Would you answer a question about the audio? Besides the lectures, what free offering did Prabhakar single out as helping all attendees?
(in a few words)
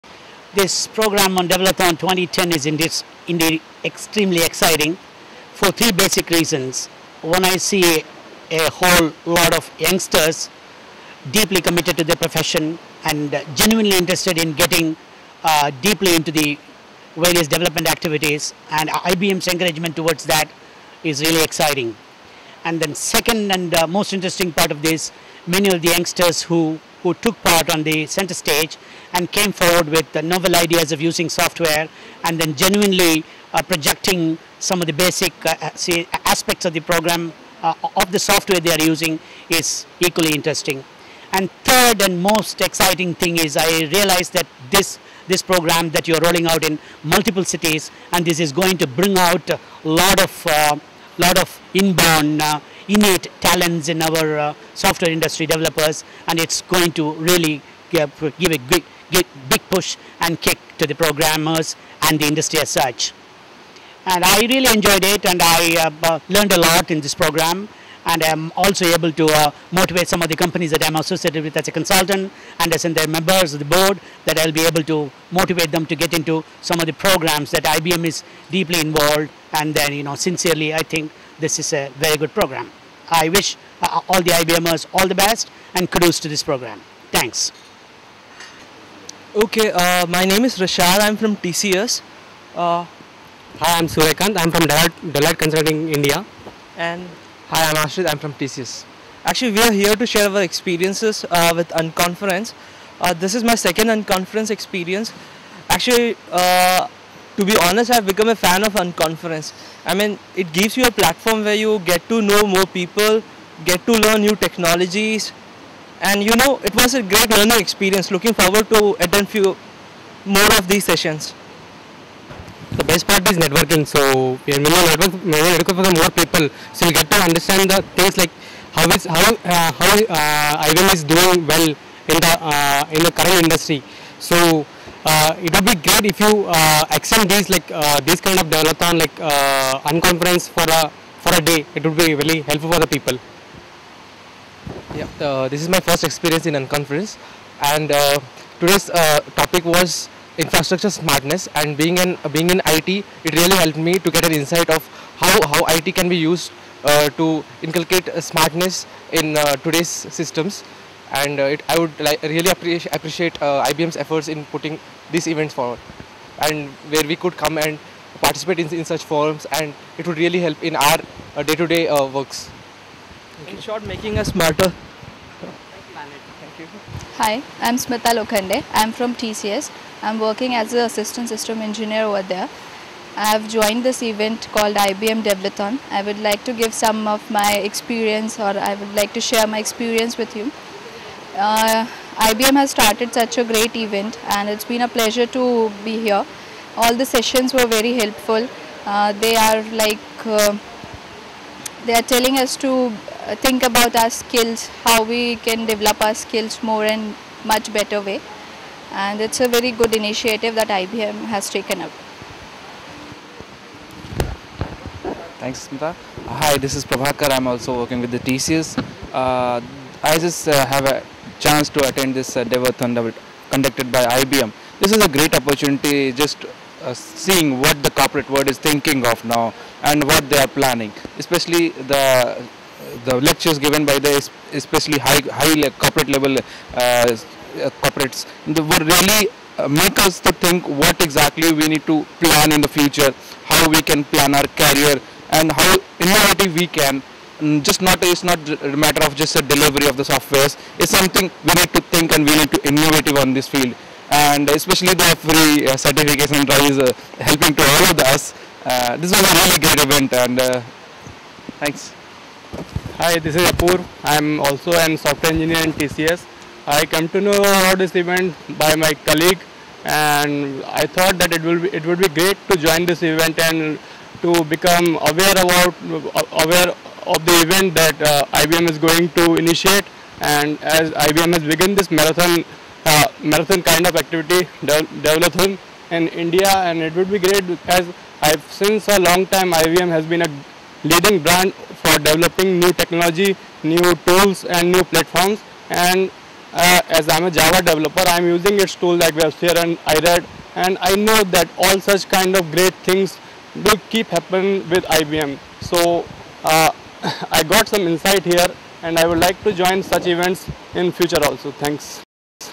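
certification drive.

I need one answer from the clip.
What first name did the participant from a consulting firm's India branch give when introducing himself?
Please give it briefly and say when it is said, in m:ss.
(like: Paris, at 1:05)
Suryakant, at 1:33.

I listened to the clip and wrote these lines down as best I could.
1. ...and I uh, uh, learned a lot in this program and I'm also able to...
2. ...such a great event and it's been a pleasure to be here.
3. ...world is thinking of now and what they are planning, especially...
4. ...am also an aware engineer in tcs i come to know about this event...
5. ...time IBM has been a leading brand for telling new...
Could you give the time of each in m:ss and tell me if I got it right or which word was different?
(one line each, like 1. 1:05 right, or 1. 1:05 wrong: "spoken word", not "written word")
1. 1:05 right
2. 3:13 right
3. 3:48 right
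4. 4:24 wrong: "software", not "aware"
5. 4:49 wrong: "developing", not "telling".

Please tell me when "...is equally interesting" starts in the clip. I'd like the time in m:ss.
0:39.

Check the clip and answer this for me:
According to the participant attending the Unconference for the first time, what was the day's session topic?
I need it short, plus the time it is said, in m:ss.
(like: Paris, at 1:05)
infrastructure smartness, at 2:30.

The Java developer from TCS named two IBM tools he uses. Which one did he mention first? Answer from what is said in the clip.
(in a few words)
WebSphere.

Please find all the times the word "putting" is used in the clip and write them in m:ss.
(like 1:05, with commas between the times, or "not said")
2:44.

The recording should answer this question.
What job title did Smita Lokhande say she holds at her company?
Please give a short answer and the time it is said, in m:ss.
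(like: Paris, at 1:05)
assistant system engineer, at 3:00.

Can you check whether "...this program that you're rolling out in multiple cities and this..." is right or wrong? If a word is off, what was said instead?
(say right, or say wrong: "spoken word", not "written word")
right.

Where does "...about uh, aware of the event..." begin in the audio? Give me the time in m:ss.
4:35.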